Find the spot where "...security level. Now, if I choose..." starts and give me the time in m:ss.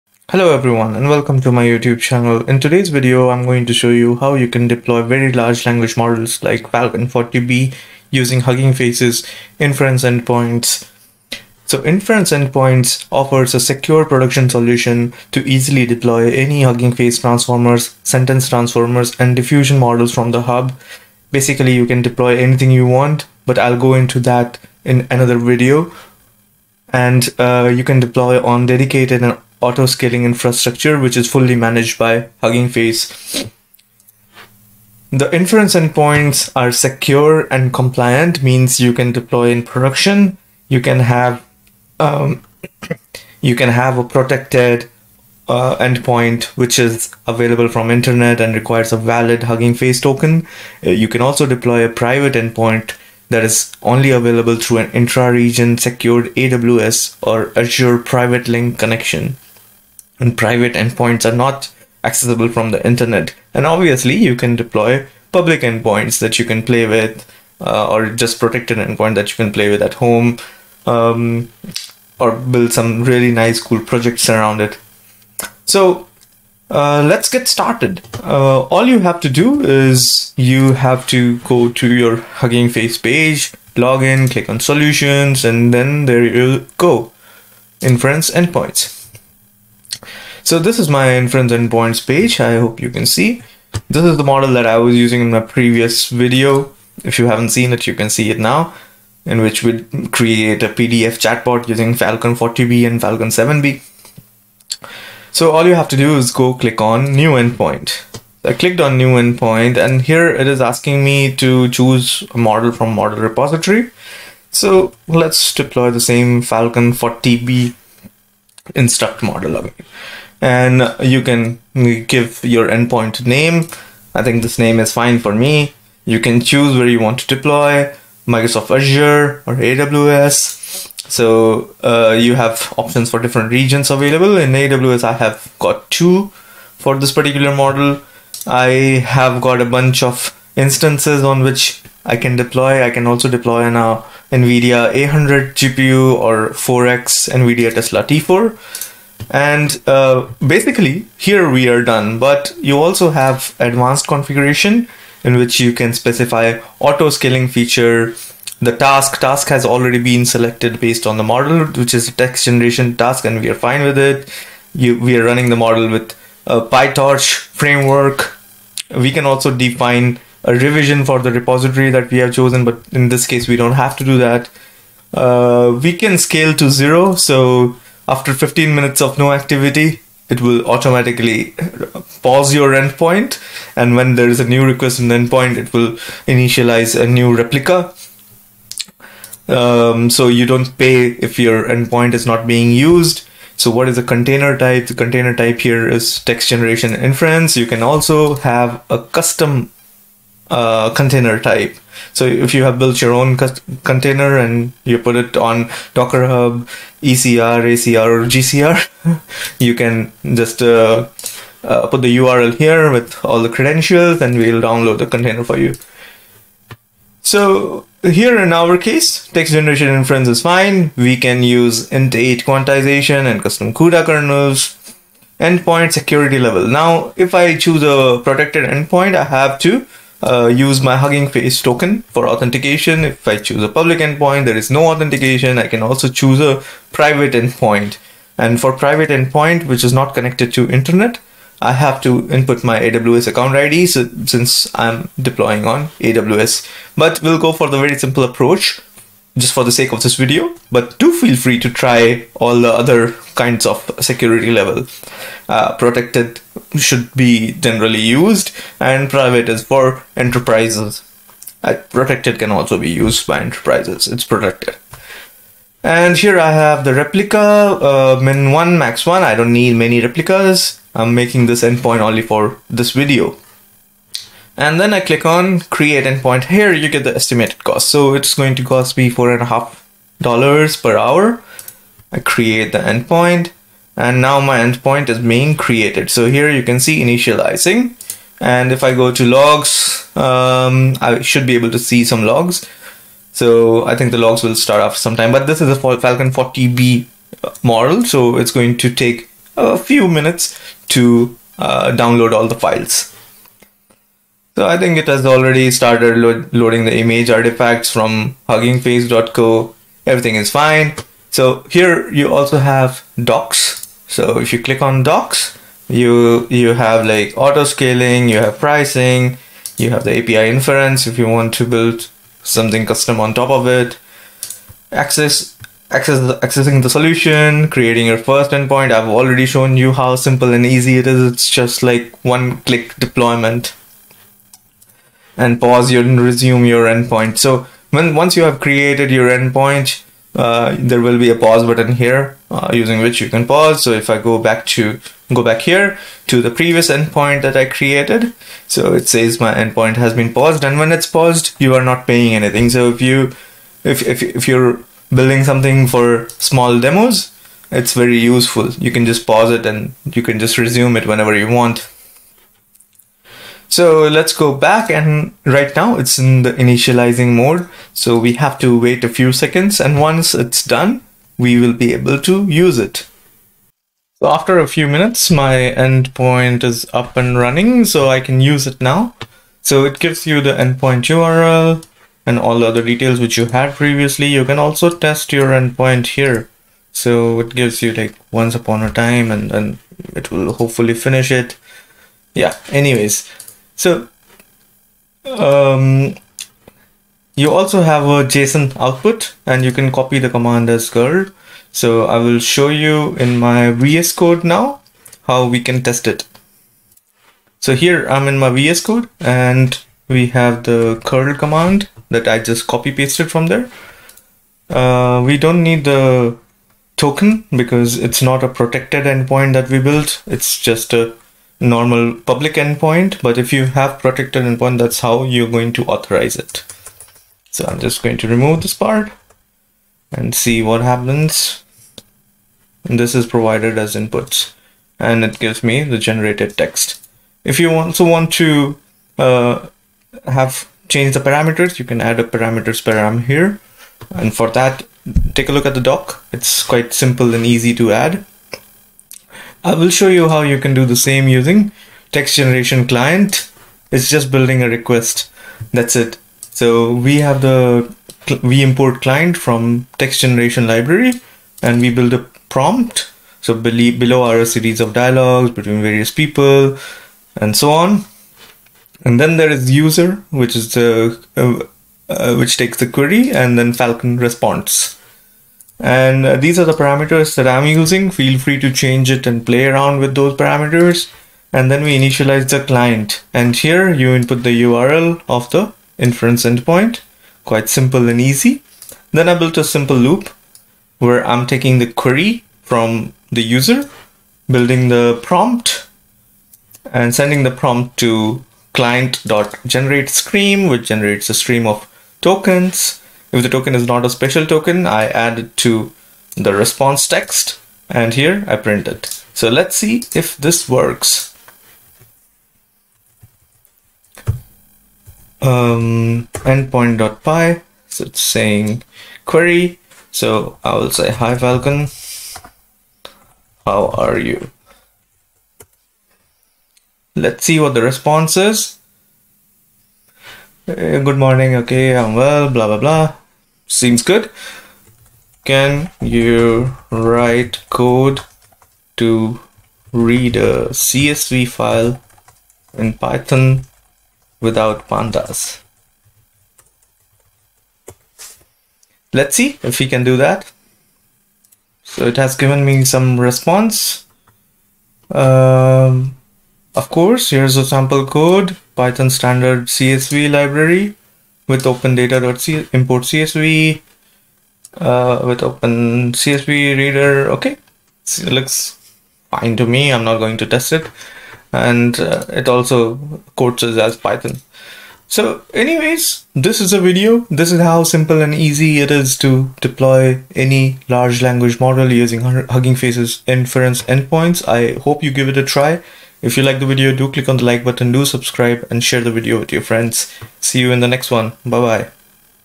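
3:45.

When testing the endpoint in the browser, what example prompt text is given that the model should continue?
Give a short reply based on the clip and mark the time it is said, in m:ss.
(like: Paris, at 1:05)
Once upon a time, at 6:28.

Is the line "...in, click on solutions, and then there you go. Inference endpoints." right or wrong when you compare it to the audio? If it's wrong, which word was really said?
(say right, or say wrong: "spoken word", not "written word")
right.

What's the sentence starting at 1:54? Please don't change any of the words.
So let's deploy the same Falcon 40B instruct model again and you can give your endpoint name.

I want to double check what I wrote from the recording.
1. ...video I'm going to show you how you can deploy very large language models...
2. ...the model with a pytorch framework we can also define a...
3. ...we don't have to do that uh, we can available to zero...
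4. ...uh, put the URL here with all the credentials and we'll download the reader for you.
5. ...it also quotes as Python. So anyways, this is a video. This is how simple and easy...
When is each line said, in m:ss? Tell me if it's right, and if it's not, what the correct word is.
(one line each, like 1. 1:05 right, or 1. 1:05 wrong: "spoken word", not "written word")
1. 0:02 right
2. 2:45 right
3. 2:53 wrong: "scale", not "available"
4. 3:31 wrong: "container", not "reader"
5. 9:32 right.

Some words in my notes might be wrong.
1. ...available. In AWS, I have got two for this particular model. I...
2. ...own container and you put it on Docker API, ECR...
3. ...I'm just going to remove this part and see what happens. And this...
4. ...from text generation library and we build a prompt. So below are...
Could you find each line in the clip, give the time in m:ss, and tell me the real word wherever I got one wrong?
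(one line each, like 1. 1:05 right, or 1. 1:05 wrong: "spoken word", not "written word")
1. 2:13 right
2. 3:23 wrong: "Hub", not "API"
3. 7:07 right
4. 7:39 right.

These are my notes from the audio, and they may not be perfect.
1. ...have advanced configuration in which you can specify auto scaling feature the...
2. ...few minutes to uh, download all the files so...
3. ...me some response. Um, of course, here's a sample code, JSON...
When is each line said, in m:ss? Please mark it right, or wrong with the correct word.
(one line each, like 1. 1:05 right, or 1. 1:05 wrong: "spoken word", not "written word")
1. 2:33 right
2. 4:59 right
3. 9:12 wrong: "Python", not "JSON".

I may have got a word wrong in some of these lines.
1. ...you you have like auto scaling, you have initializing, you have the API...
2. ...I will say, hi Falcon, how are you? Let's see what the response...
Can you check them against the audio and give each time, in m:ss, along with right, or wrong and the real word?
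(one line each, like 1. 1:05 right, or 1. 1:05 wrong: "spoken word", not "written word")
1. 5:15 wrong: "pricing", not "initializing"
2. 8:40 right.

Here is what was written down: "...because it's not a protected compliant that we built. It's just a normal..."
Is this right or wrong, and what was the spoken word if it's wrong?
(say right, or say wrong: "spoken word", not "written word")
wrong: "endpoint", not "compliant".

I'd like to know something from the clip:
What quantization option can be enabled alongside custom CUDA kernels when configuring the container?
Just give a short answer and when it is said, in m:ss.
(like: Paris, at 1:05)
int8, at 3:41.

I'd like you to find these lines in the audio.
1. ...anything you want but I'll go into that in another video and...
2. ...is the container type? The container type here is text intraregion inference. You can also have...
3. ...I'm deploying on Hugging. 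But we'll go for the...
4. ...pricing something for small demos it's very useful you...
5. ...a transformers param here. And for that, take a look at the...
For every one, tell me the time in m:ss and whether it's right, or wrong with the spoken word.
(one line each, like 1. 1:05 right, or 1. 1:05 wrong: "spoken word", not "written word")
1. 0:22 right
2. 3:13 wrong: "generation", not "intraregion"
3. 4:04 wrong: "AWS", not "Hugging"
4. 5:55 wrong: "building", not "pricing"
5. 7:22 wrong: "parameters", not "transformers".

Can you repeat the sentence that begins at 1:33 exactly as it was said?
This is the model that I was using in my previous video.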